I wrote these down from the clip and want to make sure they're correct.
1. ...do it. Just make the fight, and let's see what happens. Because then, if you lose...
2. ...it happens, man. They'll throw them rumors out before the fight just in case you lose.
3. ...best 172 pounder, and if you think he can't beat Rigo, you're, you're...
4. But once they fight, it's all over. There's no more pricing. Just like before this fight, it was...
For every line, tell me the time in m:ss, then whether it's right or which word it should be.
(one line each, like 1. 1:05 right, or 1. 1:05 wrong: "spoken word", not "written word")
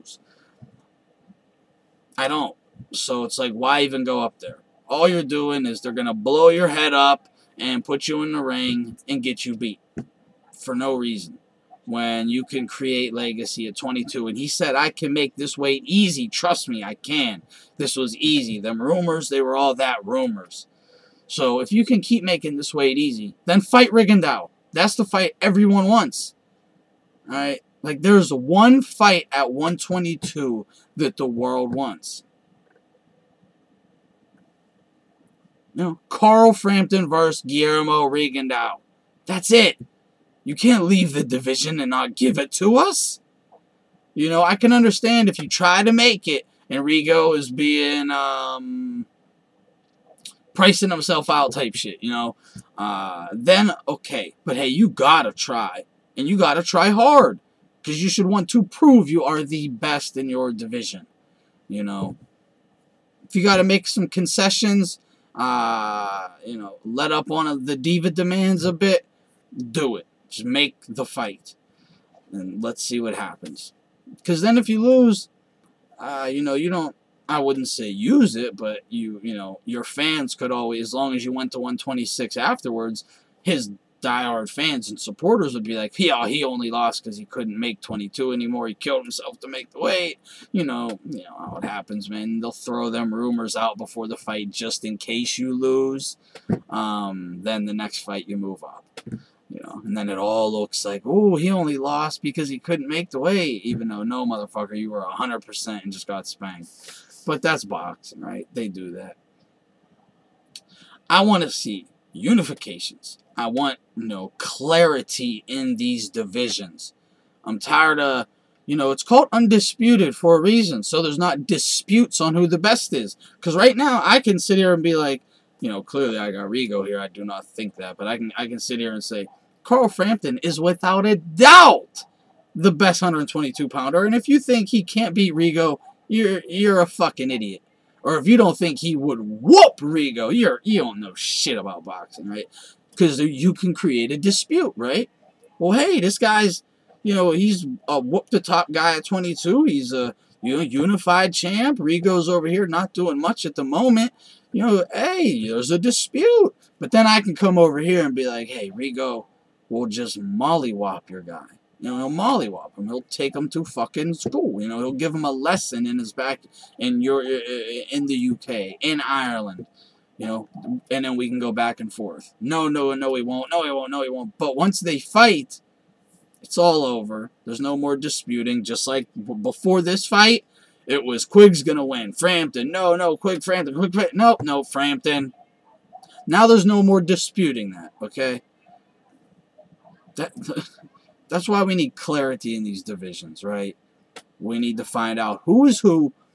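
1. 1:09 right
2. 1:31 right
3. 2:12 wrong: "122", not "172"
4. 2:54 wrong: "disputing", not "pricing".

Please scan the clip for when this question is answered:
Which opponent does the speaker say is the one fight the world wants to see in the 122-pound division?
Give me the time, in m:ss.
0:37.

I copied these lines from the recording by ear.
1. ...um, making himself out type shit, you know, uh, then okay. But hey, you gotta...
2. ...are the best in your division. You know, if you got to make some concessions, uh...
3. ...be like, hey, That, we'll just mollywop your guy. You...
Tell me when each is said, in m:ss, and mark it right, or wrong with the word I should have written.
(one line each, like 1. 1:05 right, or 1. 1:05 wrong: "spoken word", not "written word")
1. 0:48 wrong: "pricing", not "making"
2. 0:59 right
3. 2:38 wrong: "Rigo", not "That".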